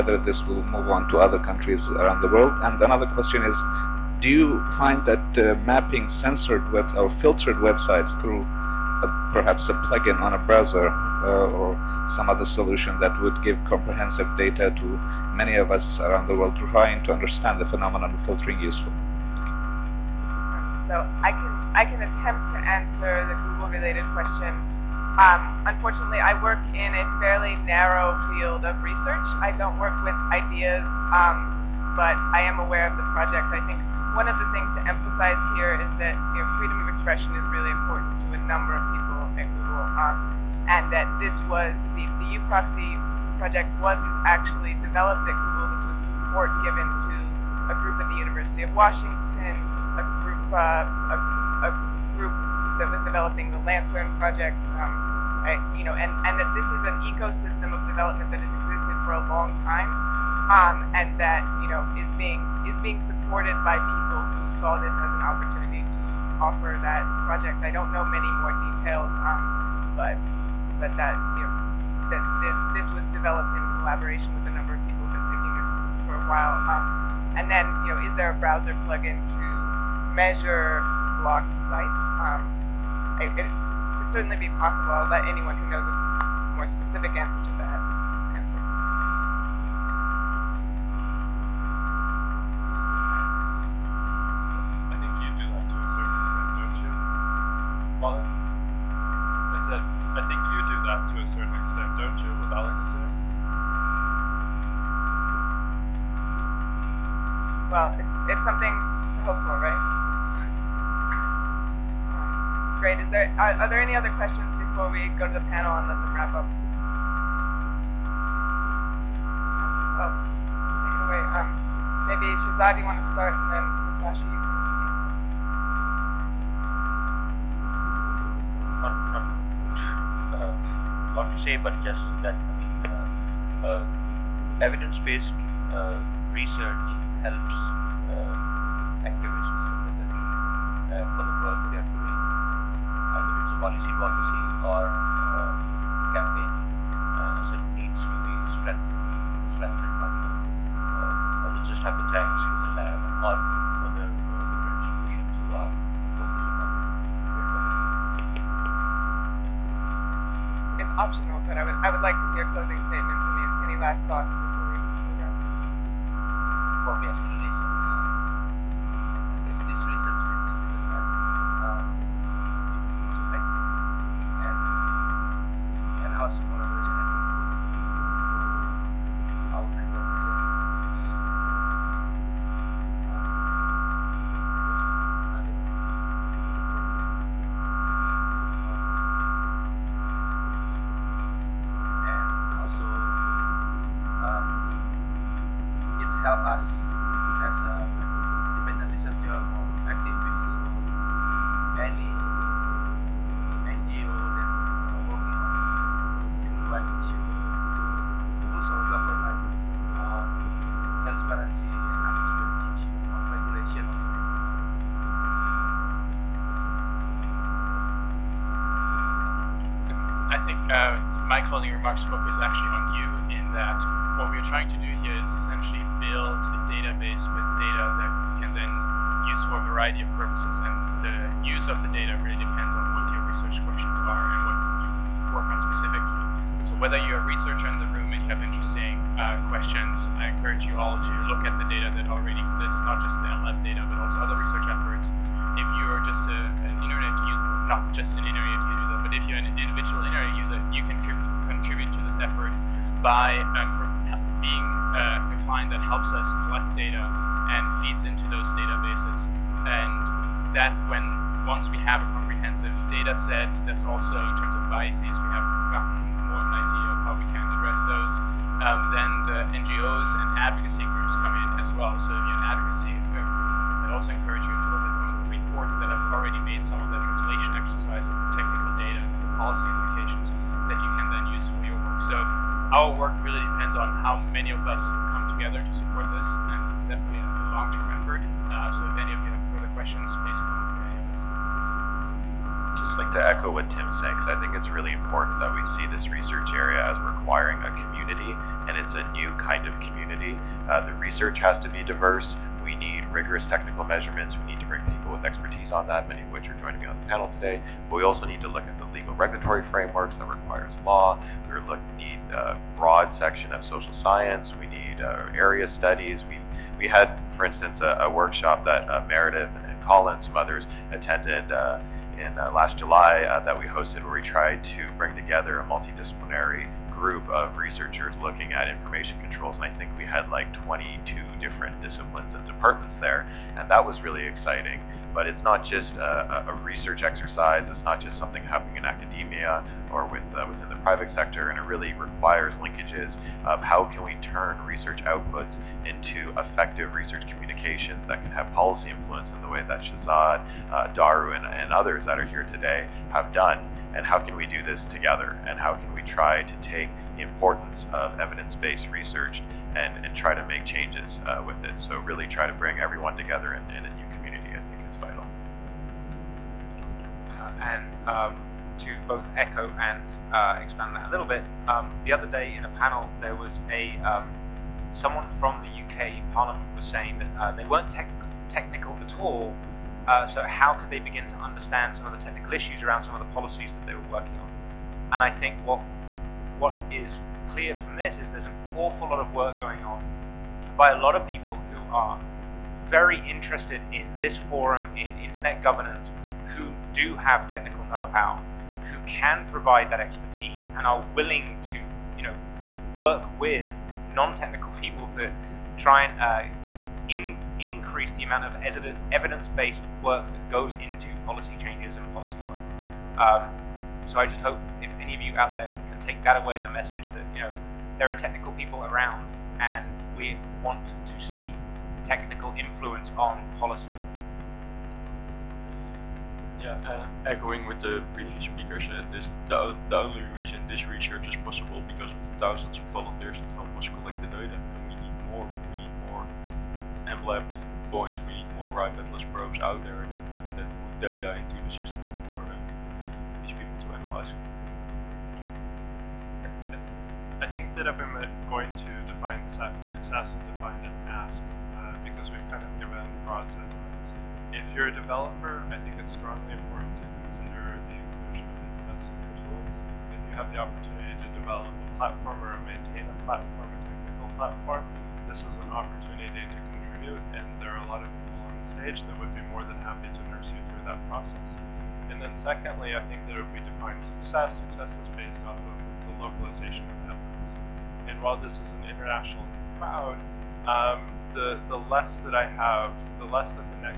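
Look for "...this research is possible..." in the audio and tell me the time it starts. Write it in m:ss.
7:10.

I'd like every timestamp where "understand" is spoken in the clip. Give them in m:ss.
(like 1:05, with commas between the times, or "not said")
0:17, 6:21.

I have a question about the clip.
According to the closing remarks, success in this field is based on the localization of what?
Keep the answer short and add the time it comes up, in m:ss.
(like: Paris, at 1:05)
Evidence, at 7:57.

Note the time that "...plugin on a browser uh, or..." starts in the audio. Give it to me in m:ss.
0:09.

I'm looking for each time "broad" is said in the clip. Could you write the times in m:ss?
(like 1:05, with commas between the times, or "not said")
5:12, 7:33.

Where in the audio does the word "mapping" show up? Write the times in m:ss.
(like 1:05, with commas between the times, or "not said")
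0:05.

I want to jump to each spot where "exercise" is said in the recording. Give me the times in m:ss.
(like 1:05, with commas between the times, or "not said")
5:37.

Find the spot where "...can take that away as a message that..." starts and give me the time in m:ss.
6:55.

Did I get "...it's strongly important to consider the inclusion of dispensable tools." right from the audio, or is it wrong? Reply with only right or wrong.
right.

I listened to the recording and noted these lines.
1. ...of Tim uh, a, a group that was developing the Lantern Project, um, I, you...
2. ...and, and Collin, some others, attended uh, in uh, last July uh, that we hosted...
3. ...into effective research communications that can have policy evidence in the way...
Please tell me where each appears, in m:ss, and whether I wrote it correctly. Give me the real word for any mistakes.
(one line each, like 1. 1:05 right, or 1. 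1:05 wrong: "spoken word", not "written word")
1. 0:48 wrong: "Washington", not "Tim"
2. 5:19 right
3. 5:45 wrong: "influence", not "evidence".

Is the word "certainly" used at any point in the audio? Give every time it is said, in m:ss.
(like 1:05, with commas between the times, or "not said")
1:24.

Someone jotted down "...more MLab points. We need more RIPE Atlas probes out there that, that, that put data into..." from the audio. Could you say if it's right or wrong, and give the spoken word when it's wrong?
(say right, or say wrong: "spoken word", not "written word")
right.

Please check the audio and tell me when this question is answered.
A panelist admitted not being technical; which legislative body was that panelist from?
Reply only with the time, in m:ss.
6:15.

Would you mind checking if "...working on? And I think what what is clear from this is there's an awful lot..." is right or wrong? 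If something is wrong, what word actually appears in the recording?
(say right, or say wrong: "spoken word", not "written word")
right.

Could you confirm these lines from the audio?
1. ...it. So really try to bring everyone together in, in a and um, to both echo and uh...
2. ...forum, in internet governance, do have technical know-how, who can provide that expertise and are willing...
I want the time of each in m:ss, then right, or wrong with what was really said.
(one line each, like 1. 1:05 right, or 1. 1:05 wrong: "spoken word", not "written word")
1. 6:01 right
2. 6:34 right.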